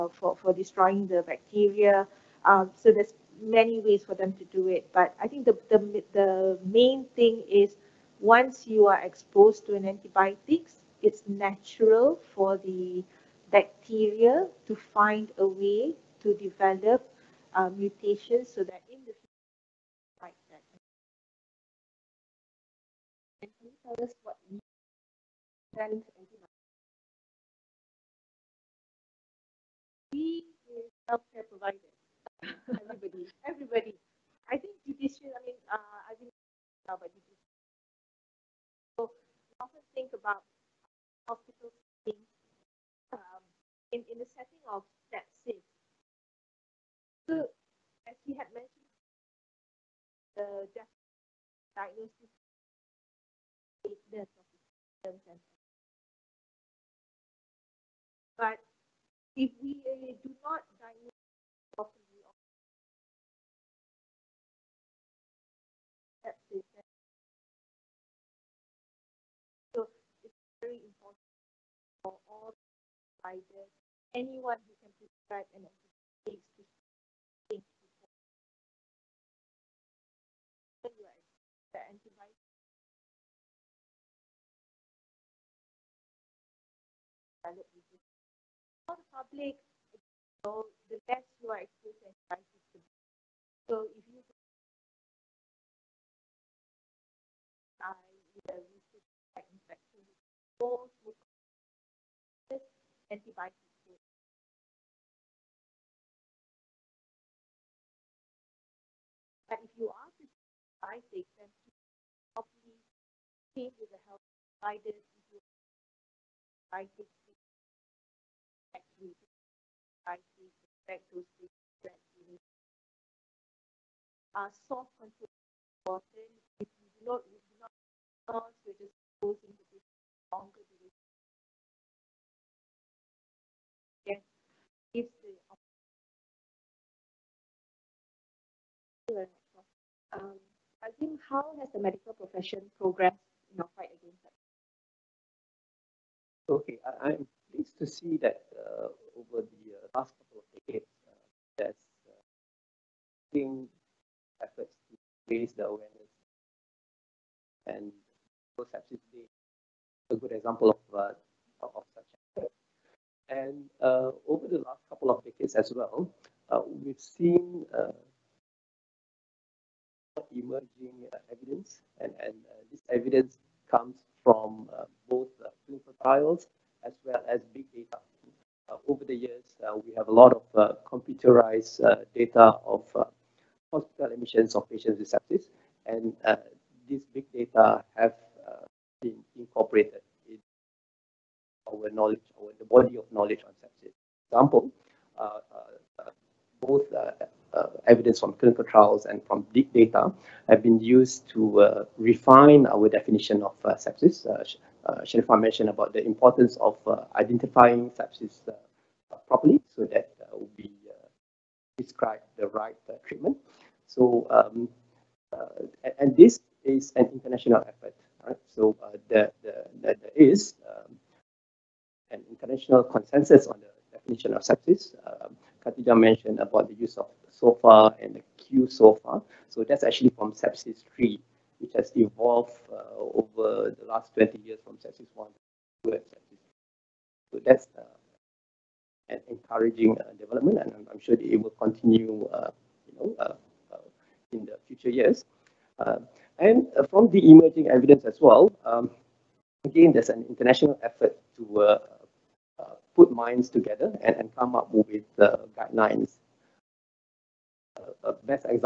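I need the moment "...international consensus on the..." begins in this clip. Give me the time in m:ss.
3:42.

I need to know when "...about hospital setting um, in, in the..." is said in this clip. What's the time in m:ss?
0:40.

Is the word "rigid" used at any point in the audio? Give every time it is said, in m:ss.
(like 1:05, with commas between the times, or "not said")
not said.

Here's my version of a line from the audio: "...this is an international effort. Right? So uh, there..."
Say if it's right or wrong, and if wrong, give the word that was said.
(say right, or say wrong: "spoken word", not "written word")
right.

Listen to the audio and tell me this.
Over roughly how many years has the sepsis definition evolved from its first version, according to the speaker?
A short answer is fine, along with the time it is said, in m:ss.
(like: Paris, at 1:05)
20 years, at 3:54.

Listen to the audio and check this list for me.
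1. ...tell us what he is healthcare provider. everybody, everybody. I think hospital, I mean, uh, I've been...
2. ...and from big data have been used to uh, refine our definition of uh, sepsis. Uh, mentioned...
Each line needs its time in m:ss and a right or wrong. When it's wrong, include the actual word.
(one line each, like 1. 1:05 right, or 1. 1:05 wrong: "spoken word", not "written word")
1. 0:23 wrong: "judicial", not "hospital"
2. 3:19 right.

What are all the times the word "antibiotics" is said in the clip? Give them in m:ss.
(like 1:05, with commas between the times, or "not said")
0:09, 1:15, 1:21, 1:43, 1:50, 1:56.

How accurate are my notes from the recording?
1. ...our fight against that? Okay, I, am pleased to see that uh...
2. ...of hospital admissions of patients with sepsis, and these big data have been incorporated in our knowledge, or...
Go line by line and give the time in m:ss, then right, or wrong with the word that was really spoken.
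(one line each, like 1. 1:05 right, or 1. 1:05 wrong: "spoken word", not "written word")
1. 2:23 right
2. 3:02 right.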